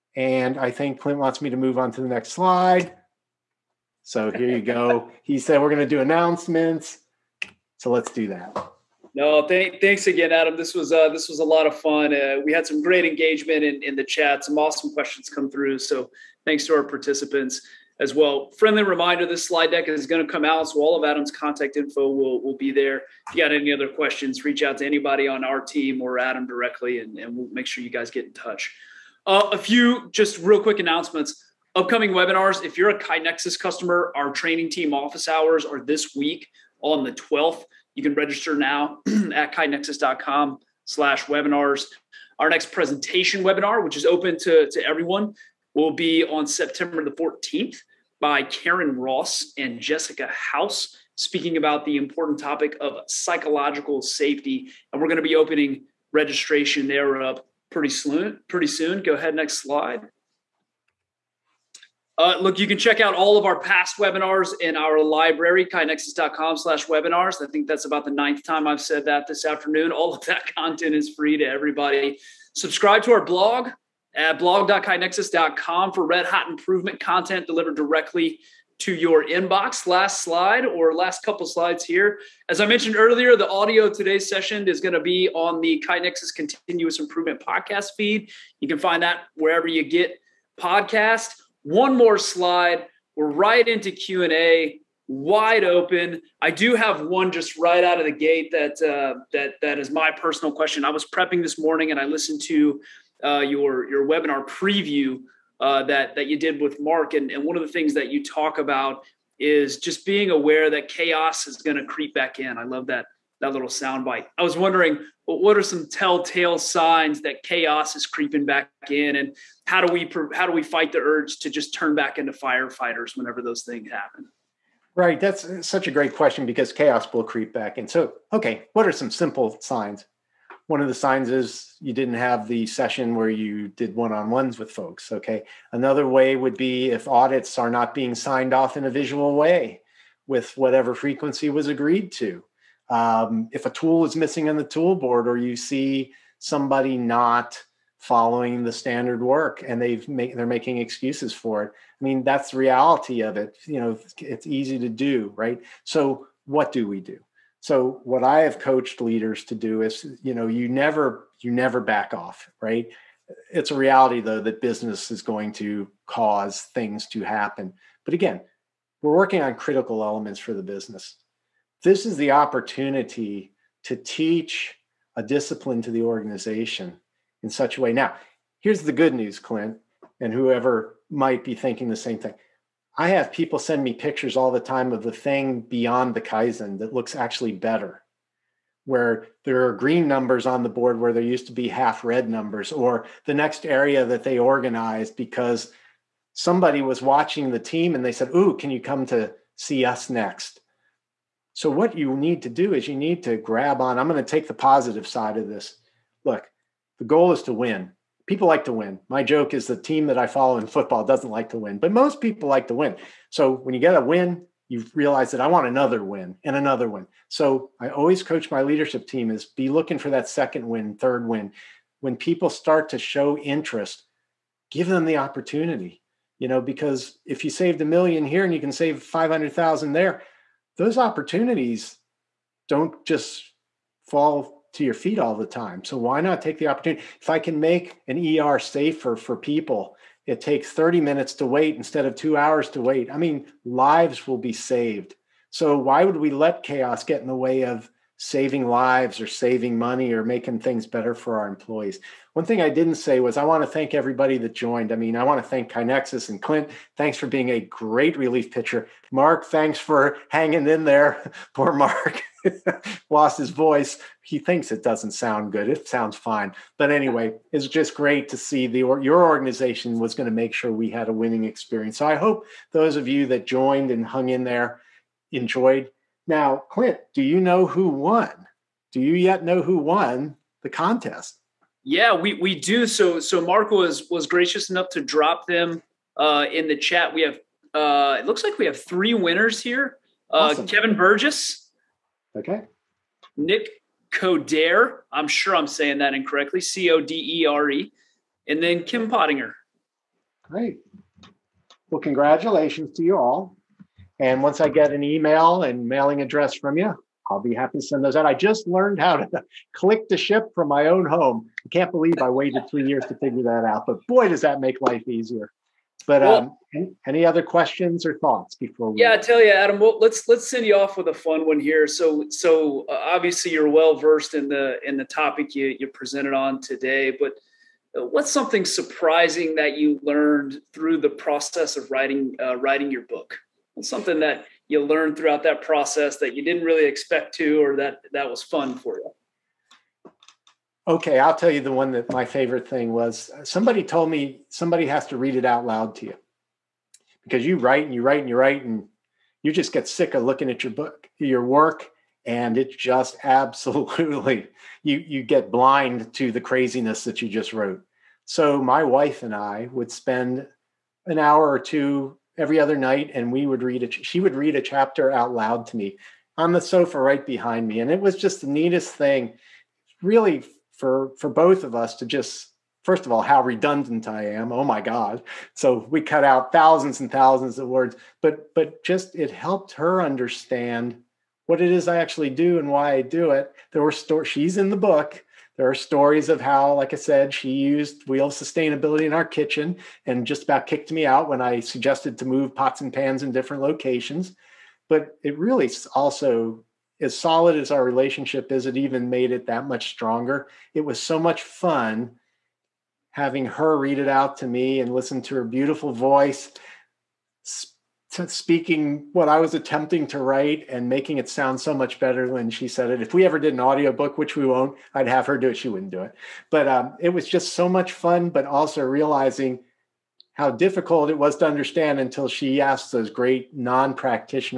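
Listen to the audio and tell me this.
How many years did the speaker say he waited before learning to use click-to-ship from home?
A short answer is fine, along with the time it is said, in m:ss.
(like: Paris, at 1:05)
3, at 5:12.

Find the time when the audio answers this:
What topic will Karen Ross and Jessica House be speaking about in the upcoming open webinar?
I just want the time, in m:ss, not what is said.
0:53.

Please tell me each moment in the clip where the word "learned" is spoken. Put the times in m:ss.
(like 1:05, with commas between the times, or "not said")
5:08, 5:30, 5:34.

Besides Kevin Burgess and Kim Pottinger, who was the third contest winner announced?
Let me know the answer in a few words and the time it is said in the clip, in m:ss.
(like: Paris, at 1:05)
Nick Codere, at 4:53.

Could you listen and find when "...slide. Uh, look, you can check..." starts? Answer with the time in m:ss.
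0:59.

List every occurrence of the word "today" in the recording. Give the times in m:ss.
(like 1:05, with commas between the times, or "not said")
1:23, 5:26.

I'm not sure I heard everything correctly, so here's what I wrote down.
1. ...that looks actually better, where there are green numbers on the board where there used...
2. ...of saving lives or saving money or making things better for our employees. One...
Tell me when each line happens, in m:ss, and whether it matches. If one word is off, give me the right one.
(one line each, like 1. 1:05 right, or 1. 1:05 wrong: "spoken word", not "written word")
1. 3:06 right
2. 4:07 right.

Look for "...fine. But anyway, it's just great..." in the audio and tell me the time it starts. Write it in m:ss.
4:26.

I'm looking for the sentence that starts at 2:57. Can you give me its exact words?
Now, here's the good news, Clint, and whoever might be thinking the same thing.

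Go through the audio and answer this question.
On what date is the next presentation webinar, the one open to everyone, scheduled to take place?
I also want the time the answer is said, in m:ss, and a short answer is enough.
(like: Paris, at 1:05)
September 14, at 0:46.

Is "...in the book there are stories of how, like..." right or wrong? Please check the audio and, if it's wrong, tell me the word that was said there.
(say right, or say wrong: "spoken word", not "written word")
right.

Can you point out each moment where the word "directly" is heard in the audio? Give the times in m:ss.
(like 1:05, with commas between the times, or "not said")
0:26, 1:17.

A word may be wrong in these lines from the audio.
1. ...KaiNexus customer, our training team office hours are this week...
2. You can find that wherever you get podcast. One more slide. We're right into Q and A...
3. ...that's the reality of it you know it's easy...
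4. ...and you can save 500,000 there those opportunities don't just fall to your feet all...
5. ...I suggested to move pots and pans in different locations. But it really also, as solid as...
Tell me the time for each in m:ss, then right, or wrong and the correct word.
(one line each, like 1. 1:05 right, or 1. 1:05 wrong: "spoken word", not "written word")
1. 0:32 right
2. 1:28 right
3. 2:32 right
4. 3:48 right
5. 6:31 right.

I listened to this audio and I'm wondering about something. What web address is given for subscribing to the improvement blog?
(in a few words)
blog.kainexus.com.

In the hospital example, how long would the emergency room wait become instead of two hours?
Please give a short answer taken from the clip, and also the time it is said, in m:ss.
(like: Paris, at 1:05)
30 minutes, at 4:00.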